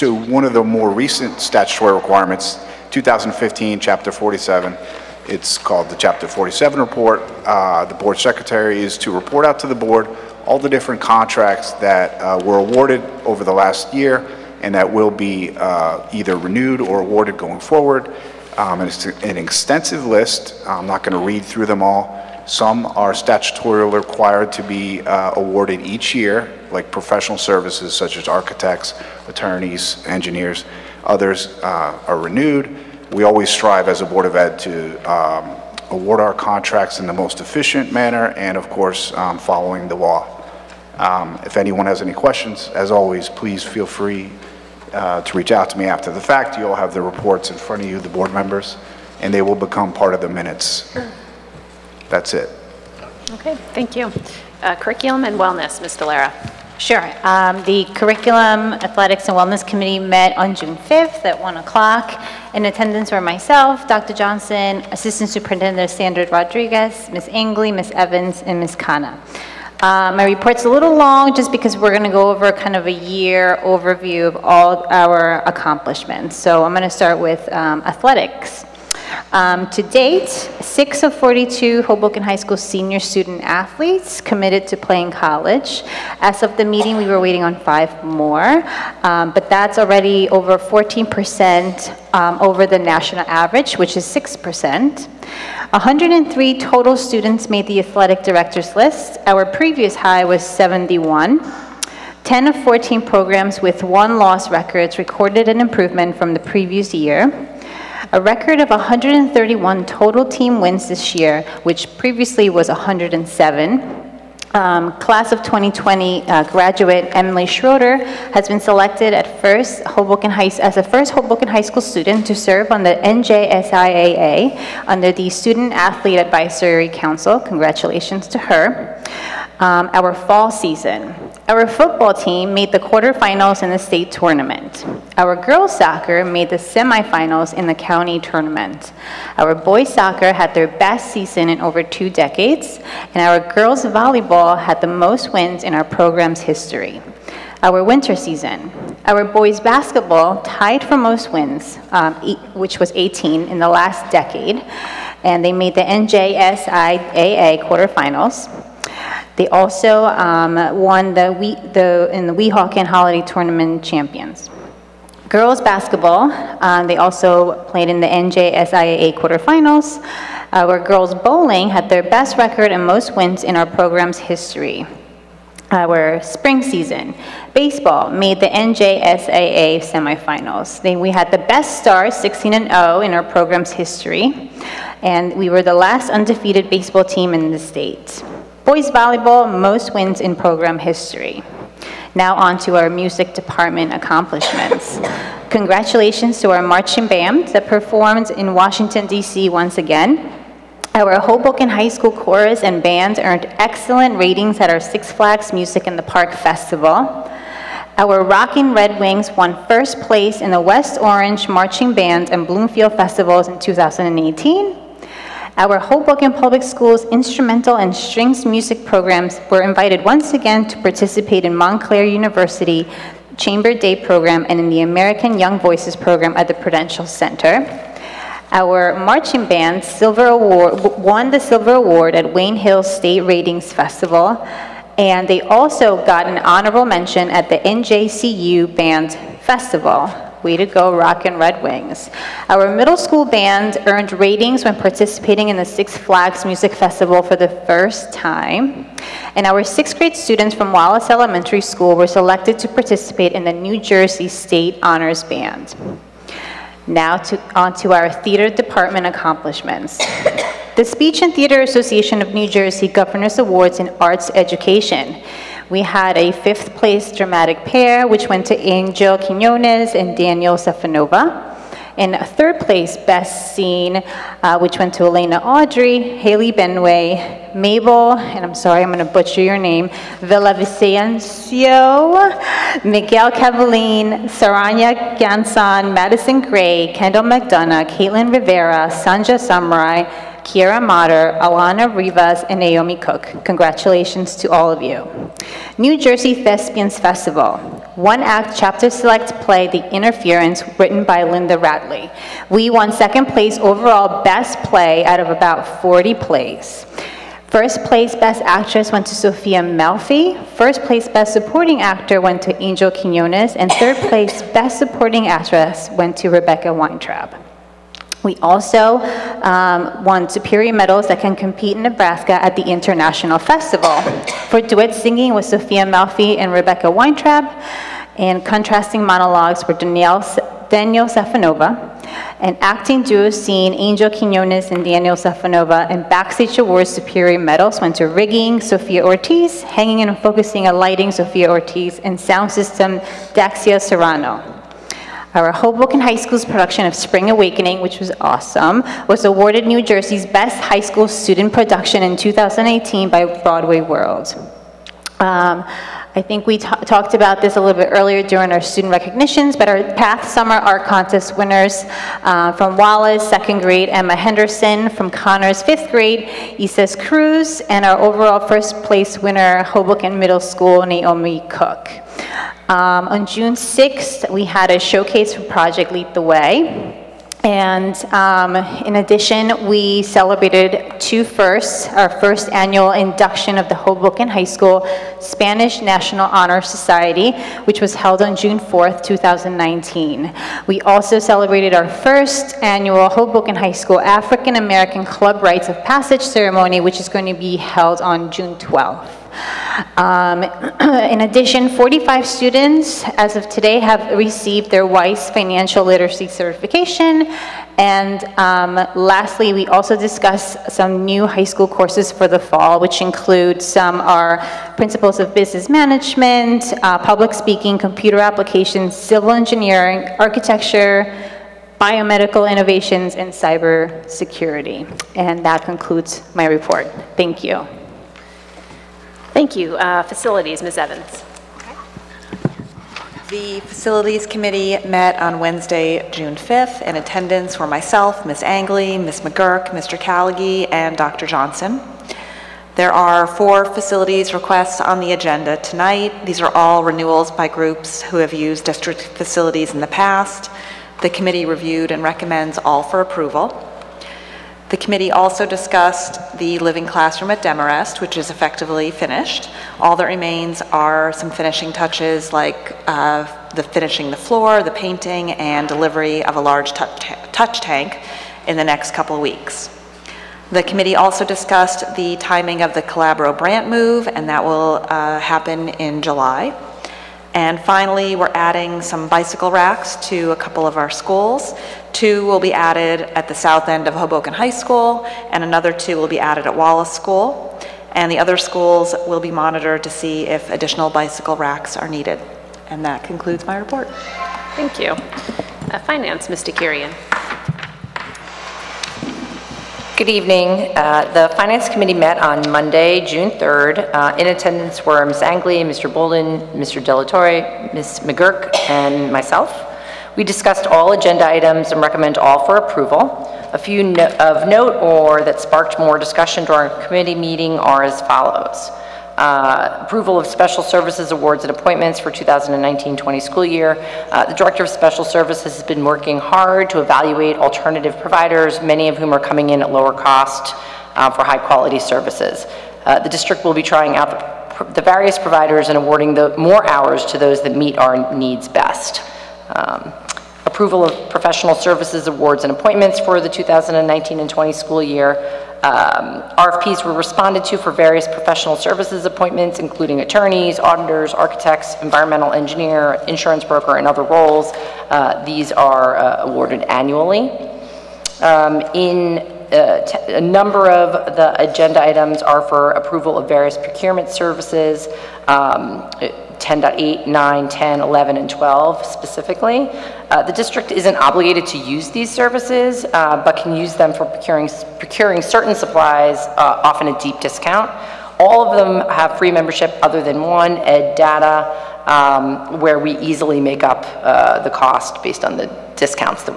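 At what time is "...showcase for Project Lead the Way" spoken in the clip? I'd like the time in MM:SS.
06:14.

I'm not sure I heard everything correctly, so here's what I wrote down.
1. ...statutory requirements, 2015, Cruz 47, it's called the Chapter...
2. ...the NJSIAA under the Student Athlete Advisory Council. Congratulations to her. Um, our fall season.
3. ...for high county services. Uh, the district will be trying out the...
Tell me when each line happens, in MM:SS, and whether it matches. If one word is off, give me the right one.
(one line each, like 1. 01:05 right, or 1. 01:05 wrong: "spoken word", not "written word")
1. 00:01 wrong: "Chapter", not "Cruz"
2. 02:02 right
3. 08:51 wrong: "quality", not "county".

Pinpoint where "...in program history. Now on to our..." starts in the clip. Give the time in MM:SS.
03:10.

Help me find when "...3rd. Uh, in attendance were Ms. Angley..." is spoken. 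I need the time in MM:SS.
08:23.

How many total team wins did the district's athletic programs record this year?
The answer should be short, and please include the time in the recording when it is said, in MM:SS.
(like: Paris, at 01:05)
131, at 01:48.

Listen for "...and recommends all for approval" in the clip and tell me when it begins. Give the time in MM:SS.
07:31.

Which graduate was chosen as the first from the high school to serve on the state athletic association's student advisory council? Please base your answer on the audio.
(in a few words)
Emily Schroeder.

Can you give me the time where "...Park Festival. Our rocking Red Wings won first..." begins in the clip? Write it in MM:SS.
03:26.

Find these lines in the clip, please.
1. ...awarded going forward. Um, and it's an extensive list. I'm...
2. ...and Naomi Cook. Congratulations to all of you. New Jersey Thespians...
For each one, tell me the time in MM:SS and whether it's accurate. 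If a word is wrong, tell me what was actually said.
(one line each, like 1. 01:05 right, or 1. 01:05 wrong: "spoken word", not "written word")
1. 00:17 right
2. 04:52 right.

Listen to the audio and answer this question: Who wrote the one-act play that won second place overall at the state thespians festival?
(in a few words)
Linda Radley.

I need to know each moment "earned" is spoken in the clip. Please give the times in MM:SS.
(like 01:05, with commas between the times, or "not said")
03:23, 04:03.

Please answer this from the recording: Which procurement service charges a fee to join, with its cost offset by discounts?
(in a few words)
ed data.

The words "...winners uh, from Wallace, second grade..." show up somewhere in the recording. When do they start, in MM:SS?
06:01.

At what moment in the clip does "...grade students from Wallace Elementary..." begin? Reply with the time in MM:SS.
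04:09.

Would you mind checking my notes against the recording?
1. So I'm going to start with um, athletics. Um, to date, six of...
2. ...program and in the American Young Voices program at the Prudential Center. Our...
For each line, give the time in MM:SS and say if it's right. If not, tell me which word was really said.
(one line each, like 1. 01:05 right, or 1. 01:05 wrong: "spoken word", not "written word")
1. 01:16 right
2. 03:43 right.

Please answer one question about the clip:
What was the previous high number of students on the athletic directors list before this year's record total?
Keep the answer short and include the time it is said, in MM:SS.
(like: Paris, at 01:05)
71, at 01:40.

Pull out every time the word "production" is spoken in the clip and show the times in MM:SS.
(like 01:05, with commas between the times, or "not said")
05:46, 05:51.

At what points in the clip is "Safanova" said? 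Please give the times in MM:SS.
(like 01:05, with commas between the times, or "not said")
04:30, 05:31, 05:35.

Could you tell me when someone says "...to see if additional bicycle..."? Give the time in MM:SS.
08:09.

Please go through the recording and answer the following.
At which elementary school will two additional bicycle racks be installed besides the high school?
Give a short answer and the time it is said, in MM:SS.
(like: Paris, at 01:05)
Wallace School, at 08:06.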